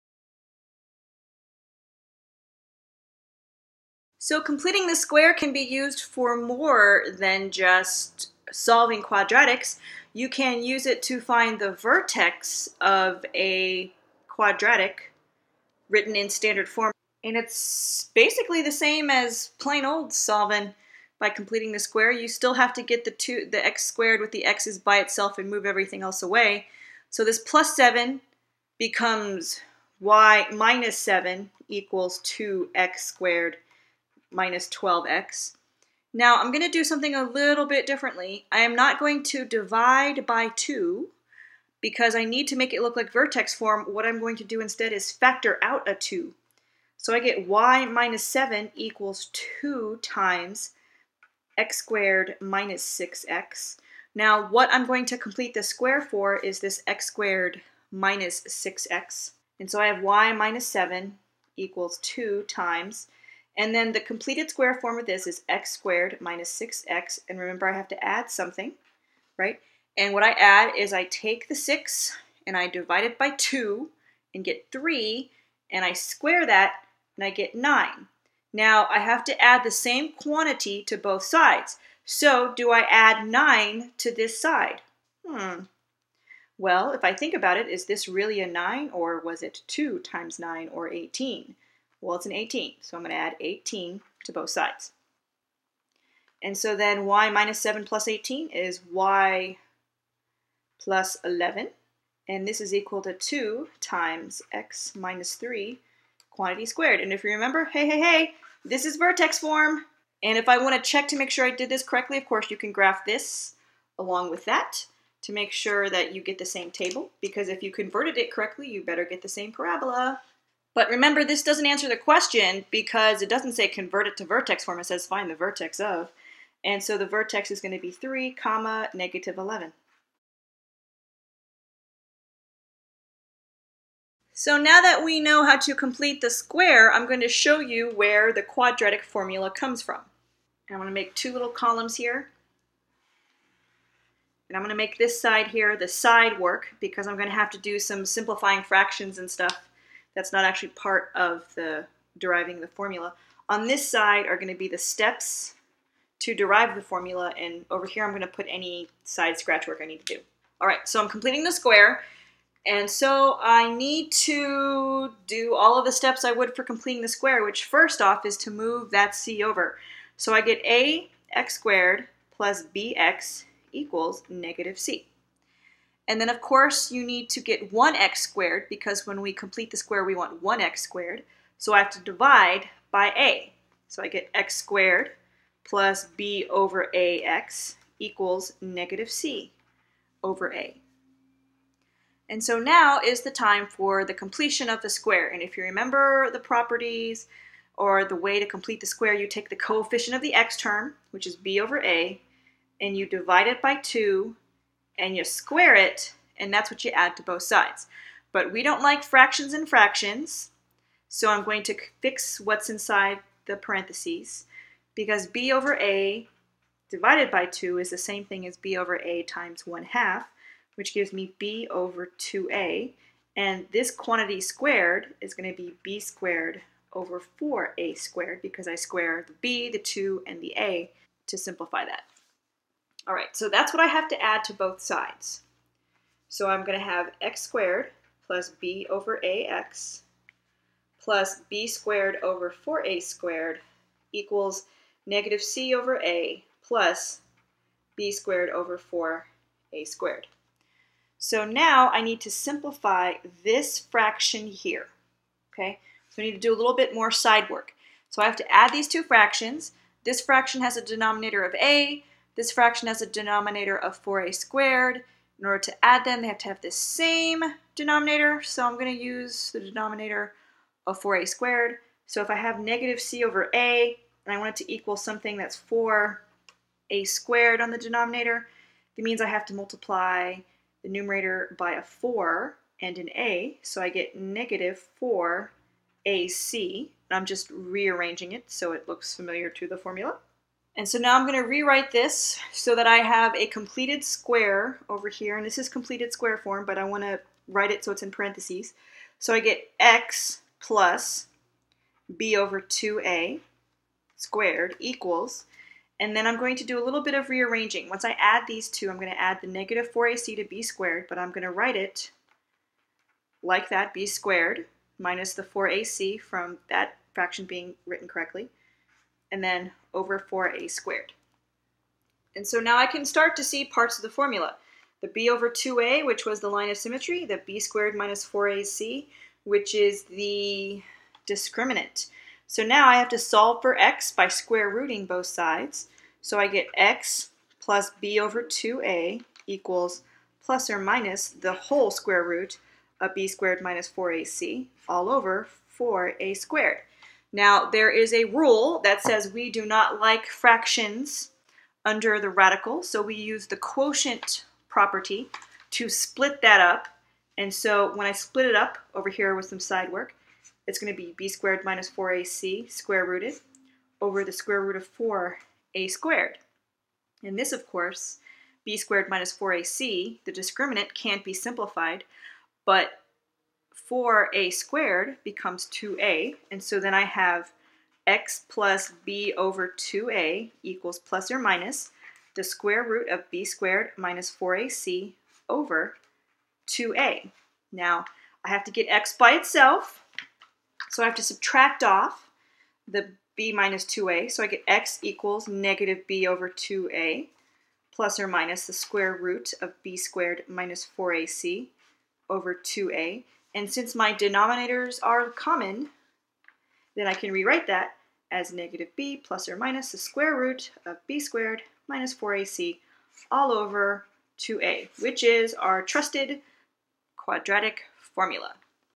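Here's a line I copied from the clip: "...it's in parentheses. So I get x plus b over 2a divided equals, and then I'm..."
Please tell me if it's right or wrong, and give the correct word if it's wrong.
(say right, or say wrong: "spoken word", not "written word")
wrong: "squared", not "divided".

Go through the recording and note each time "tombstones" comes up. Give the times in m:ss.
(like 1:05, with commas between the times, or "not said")
not said.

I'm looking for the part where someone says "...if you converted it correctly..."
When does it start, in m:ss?
1:57.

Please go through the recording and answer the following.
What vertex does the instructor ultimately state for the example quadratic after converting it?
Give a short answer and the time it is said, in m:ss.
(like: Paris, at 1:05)
(3, -11), at 2:07.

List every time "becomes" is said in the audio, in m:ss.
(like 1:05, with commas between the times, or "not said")
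0:28, 6:15.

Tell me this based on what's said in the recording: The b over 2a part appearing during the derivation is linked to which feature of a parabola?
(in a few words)
line of symmetry.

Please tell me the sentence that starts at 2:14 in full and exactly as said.
So now that we know how to complete the square, I'm going to show you where the quadratic formula comes from.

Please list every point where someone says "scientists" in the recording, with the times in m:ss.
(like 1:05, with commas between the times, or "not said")
not said.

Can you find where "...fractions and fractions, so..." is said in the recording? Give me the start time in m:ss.
3:29.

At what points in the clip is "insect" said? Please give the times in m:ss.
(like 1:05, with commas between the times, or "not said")
not said.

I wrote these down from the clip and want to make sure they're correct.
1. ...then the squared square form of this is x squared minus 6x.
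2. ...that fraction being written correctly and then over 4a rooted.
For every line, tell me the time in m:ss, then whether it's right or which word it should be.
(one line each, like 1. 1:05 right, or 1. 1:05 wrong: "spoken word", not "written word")
1. 1:03 wrong: "completed", not "squared"
2. 5:16 wrong: "squared", not "rooted".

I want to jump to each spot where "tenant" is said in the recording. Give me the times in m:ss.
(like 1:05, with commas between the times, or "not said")
not said.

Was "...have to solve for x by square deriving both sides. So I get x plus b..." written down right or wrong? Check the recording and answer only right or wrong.
wrong.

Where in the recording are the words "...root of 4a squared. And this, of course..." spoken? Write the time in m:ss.
6:04.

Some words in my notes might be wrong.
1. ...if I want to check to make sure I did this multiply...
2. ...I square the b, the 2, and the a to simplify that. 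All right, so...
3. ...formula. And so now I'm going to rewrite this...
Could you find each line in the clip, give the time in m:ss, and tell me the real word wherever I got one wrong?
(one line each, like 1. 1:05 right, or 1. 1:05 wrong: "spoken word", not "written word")
1. 1:50 wrong: "correctly", not "multiply"
2. 3:48 right
3. 4:49 right.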